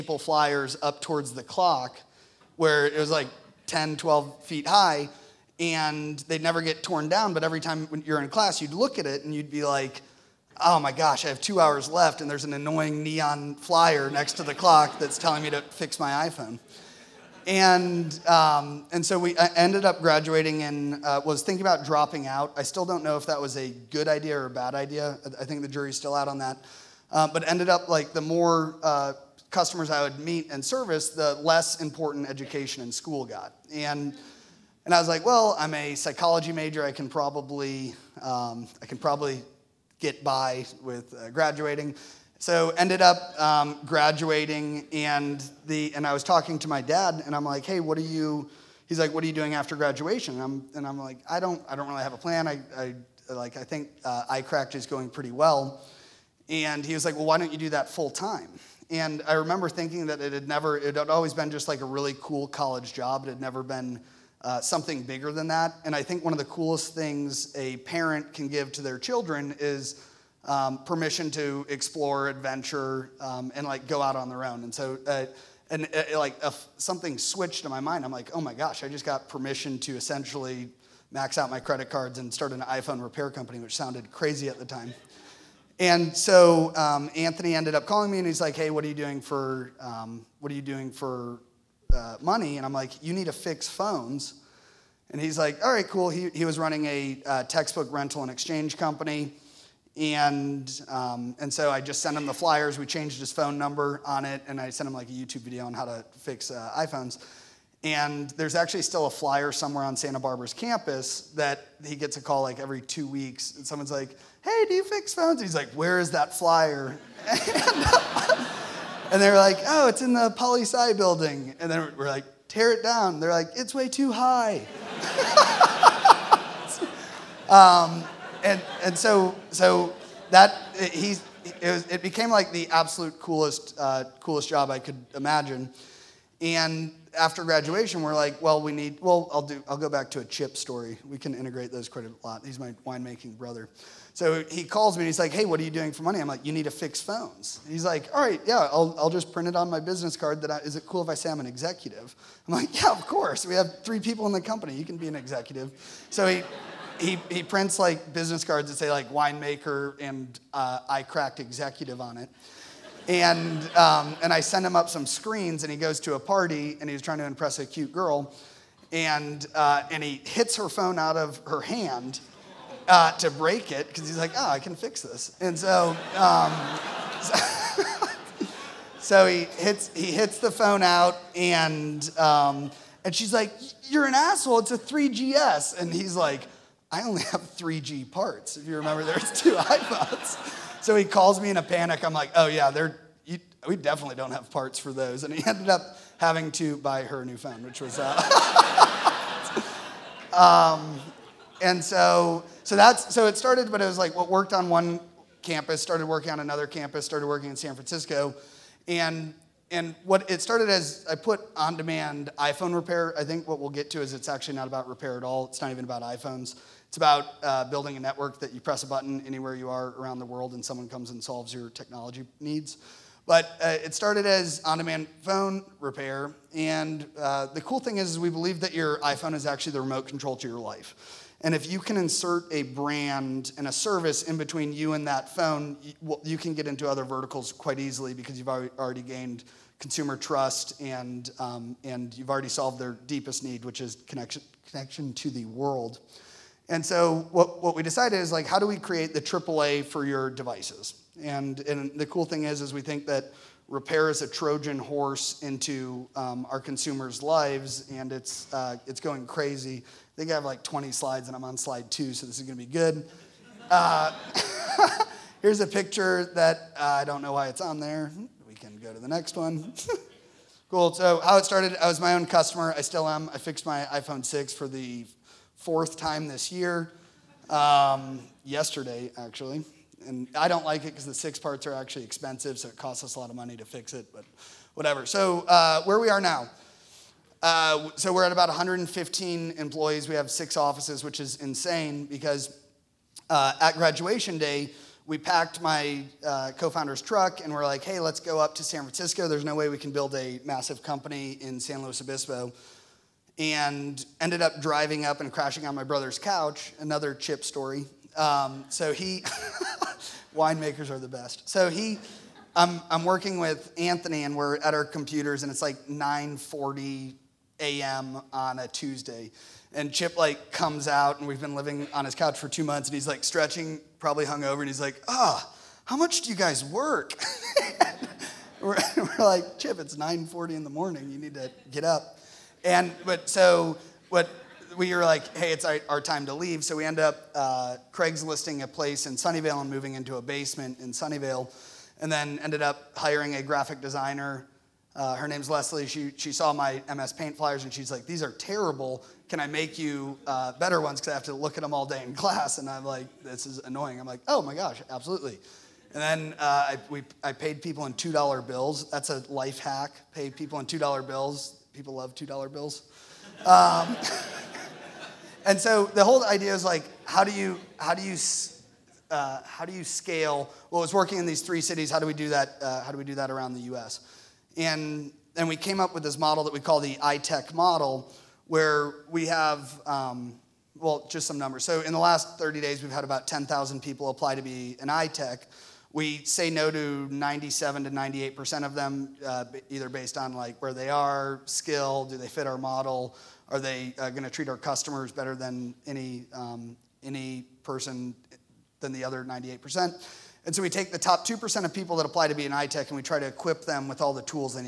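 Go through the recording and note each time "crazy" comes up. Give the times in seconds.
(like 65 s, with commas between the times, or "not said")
84 s, 259 s.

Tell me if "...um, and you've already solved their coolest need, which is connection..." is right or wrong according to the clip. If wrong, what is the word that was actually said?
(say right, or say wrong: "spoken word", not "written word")
wrong: "deepest", not "coolest".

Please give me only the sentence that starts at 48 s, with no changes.
He's like, what are you doing after graduation?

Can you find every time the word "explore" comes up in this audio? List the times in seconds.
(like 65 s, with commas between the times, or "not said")
71 s.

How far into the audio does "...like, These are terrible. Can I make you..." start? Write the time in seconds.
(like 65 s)
347 s.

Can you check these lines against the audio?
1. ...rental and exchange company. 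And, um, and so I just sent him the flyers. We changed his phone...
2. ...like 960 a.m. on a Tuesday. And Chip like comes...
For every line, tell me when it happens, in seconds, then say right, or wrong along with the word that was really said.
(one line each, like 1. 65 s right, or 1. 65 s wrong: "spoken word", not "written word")
1. 97 s right
2. 315 s wrong: "940", not "960".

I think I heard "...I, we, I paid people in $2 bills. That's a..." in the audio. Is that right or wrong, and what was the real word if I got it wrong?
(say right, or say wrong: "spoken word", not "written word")
right.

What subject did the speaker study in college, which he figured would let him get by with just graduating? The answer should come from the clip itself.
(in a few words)
Psychology.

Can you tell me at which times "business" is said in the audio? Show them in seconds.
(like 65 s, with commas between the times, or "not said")
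149 s, 158 s.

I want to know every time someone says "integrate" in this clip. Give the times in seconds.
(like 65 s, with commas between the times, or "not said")
141 s.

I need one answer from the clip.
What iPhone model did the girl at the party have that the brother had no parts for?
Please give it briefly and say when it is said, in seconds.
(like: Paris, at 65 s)
3GS, at 184 s.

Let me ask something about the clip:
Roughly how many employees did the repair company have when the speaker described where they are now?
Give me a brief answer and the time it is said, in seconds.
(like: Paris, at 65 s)
115, at 288 s.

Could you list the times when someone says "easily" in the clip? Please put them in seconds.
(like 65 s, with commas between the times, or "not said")
237 s.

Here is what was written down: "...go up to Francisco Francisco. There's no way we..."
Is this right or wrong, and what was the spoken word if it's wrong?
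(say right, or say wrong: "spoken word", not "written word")
wrong: "San", not "Francisco".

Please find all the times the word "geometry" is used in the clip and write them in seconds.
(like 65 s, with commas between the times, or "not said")
not said.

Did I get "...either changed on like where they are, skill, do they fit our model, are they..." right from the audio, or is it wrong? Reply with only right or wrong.
wrong.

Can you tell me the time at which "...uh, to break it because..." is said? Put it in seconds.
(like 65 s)
172 s.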